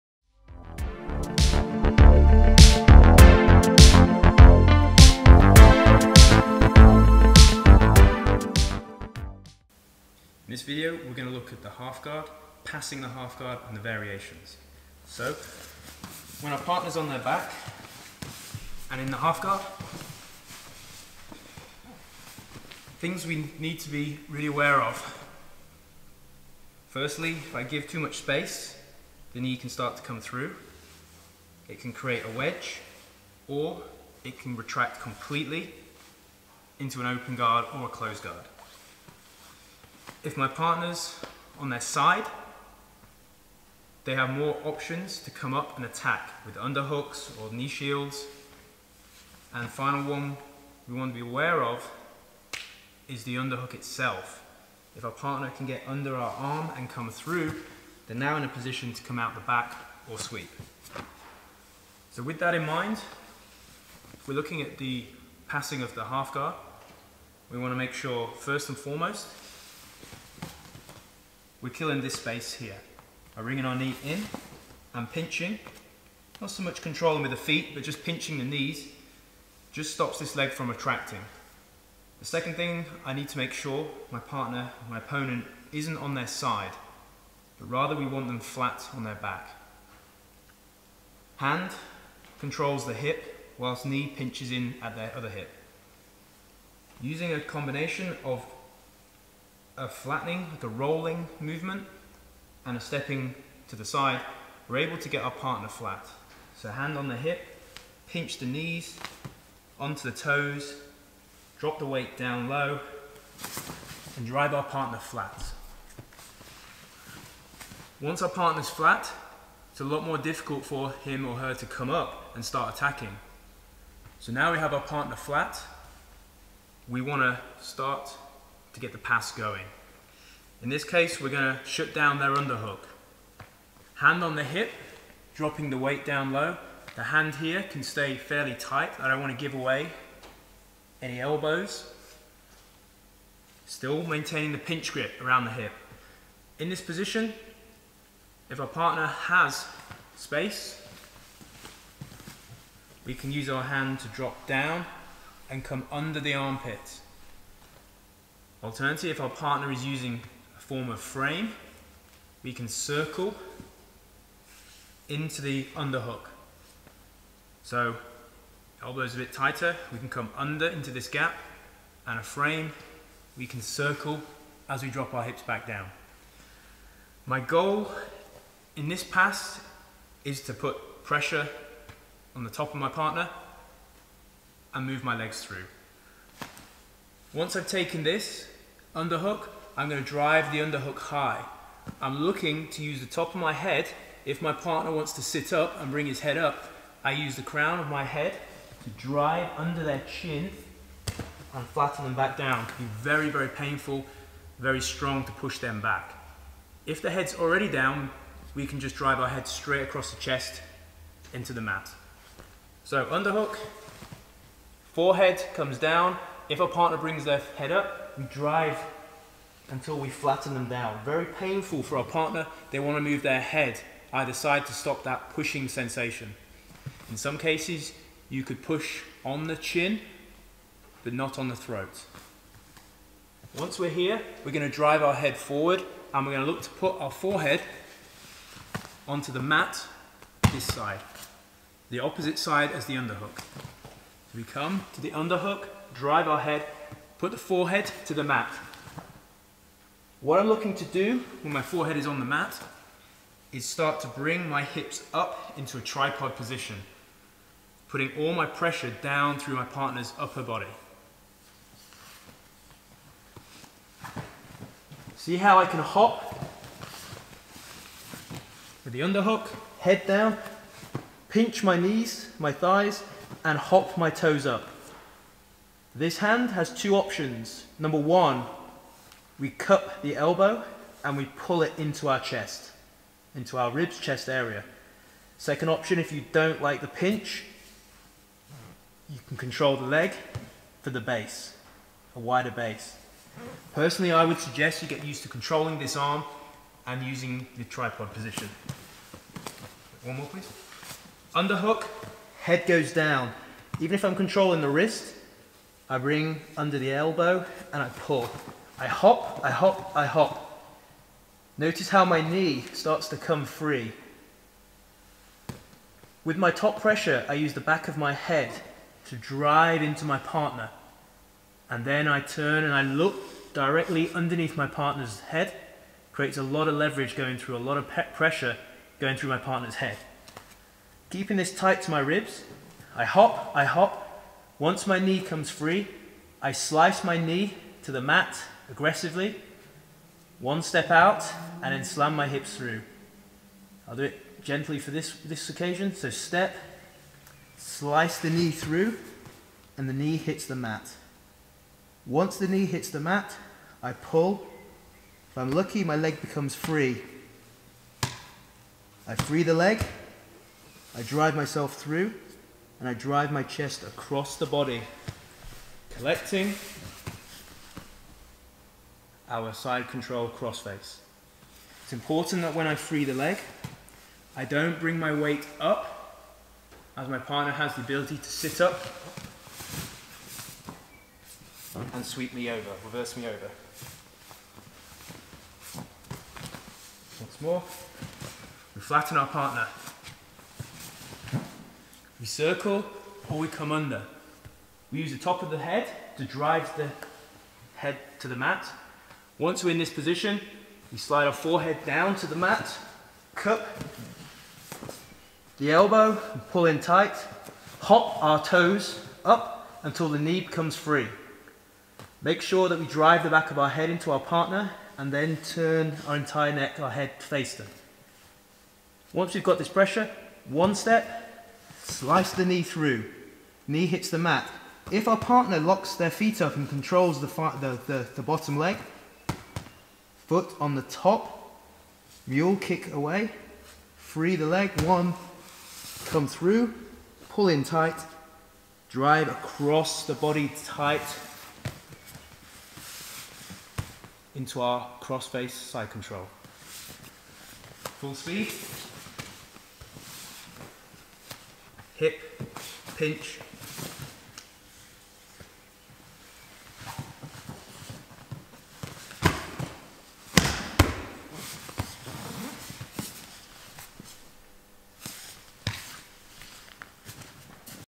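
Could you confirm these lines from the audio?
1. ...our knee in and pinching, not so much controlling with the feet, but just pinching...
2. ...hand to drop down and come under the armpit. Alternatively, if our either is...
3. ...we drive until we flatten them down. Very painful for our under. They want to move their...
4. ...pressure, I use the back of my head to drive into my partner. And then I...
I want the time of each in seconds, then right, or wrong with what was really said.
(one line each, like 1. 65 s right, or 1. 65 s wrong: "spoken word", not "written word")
1. 73 s right
2. 153 s wrong: "partner", not "either"
3. 218 s wrong: "partner", not "under"
4. 316 s right.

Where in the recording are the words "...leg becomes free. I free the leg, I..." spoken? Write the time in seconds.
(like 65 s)
355 s.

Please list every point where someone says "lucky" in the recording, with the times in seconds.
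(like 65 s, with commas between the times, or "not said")
355 s.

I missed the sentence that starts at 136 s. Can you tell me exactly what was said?
The hand here can stay fairly tight.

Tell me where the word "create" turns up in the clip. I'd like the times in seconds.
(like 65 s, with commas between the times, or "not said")
31 s, 326 s.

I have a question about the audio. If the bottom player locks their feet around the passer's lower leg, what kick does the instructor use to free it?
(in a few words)
Mule kick.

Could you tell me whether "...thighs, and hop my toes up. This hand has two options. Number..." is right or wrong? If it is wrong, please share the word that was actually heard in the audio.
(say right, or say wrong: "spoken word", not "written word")
right.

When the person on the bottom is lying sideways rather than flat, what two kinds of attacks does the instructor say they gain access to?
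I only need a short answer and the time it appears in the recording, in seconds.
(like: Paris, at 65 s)
Underhooks or knee shields, at 46 s.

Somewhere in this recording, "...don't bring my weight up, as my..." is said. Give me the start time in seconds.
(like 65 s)
374 s.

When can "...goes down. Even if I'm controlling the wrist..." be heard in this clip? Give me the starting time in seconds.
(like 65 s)
302 s.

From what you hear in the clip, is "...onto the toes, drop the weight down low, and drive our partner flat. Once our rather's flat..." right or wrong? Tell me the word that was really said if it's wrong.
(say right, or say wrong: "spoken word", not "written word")
wrong: "partner", not "rather".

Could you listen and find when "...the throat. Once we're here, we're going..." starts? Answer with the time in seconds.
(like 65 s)
231 s.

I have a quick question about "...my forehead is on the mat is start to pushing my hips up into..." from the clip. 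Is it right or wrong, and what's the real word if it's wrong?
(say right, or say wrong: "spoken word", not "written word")
wrong: "bring", not "pushing".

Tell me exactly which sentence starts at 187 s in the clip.
Once I've taken this, Underhook, I'm going to drive the underhook high.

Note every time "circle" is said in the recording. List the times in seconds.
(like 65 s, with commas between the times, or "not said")
162 s, 173 s, 392 s.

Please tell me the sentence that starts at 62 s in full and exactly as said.
So with that in mind, we're looking at the passing of the half guard.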